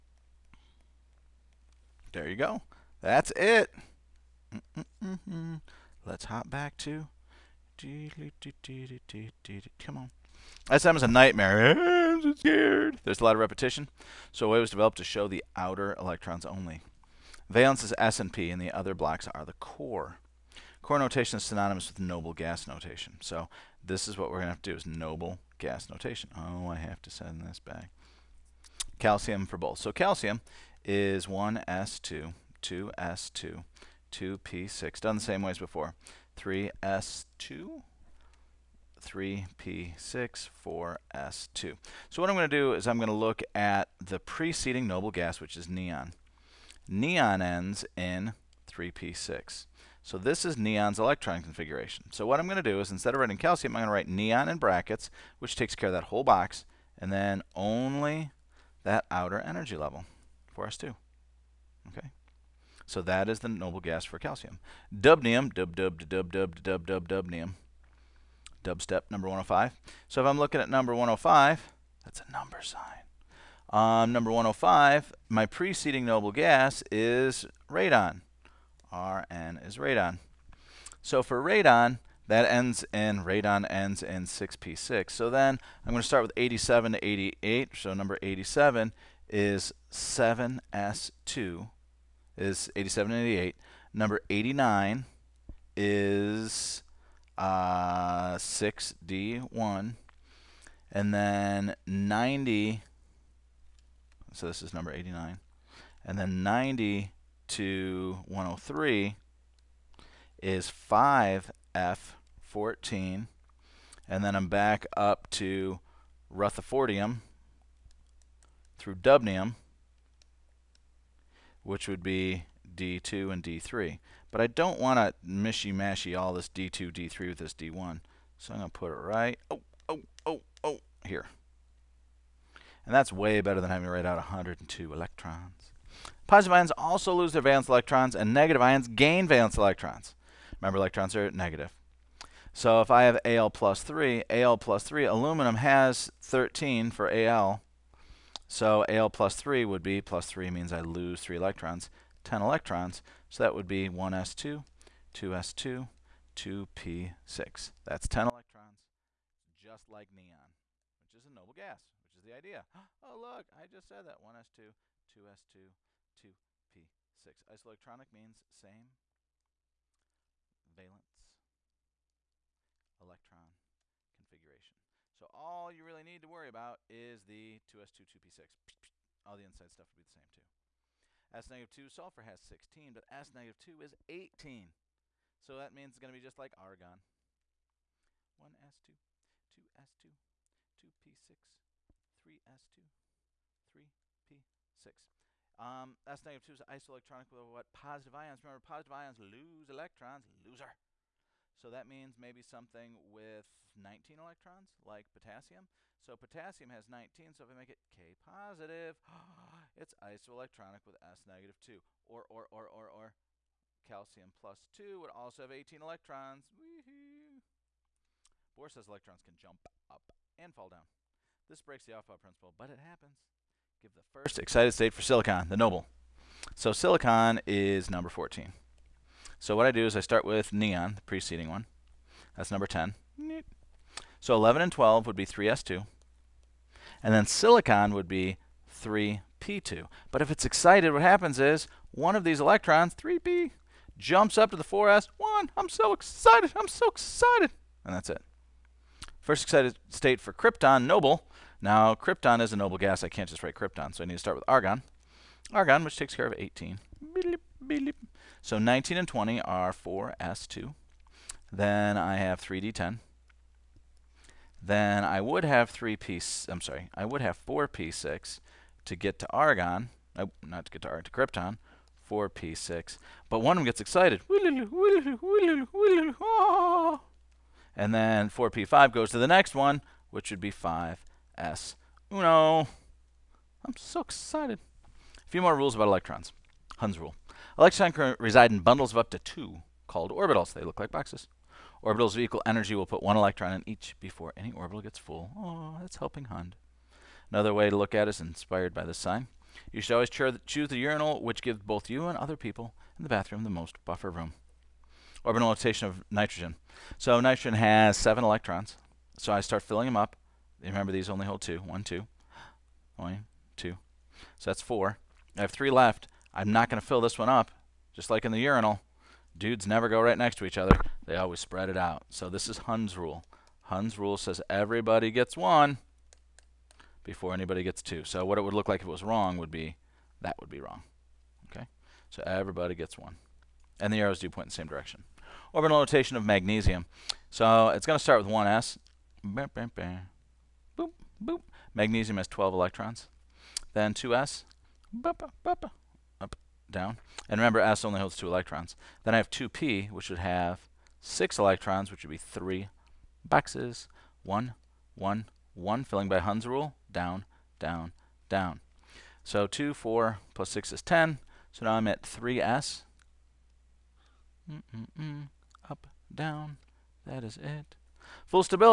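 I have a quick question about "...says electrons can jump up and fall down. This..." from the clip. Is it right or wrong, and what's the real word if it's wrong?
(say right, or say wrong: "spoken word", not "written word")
right.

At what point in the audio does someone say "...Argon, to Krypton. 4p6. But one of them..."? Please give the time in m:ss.
4:30.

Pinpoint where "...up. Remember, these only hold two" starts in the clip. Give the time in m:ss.
5:09.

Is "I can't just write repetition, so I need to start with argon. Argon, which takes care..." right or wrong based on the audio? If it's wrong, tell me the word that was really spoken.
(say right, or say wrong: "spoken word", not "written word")
wrong: "krypton", not "repetition".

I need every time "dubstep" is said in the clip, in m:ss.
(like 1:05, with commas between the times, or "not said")
1:08.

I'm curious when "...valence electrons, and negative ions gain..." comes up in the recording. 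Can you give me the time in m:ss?
2:17.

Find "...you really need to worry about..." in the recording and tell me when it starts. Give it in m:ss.
2:55.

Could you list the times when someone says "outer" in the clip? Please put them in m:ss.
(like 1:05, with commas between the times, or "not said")
0:15, 0:59.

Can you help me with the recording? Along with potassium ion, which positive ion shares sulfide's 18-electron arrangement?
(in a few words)
Calcium plus 2.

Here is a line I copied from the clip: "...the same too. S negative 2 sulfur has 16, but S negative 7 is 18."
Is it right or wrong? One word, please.
wrong.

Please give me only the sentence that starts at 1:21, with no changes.
So for radon, that ends in, radon ends in 6p6.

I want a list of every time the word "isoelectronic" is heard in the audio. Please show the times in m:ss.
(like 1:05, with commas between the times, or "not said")
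2:47, 3:16, 3:30.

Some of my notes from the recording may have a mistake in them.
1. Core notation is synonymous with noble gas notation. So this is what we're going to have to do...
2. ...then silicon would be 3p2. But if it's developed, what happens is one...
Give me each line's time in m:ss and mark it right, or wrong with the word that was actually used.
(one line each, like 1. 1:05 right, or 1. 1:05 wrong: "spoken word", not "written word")
1. 0:20 right
2. 3:57 wrong: "excited", not "developed".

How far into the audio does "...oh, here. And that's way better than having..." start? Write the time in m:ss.
2:10.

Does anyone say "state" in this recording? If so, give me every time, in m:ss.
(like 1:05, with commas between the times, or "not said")
3:44, 4:09.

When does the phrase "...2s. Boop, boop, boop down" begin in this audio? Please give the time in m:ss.
5:43.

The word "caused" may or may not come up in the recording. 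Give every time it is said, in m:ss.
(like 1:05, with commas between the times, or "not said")
not said.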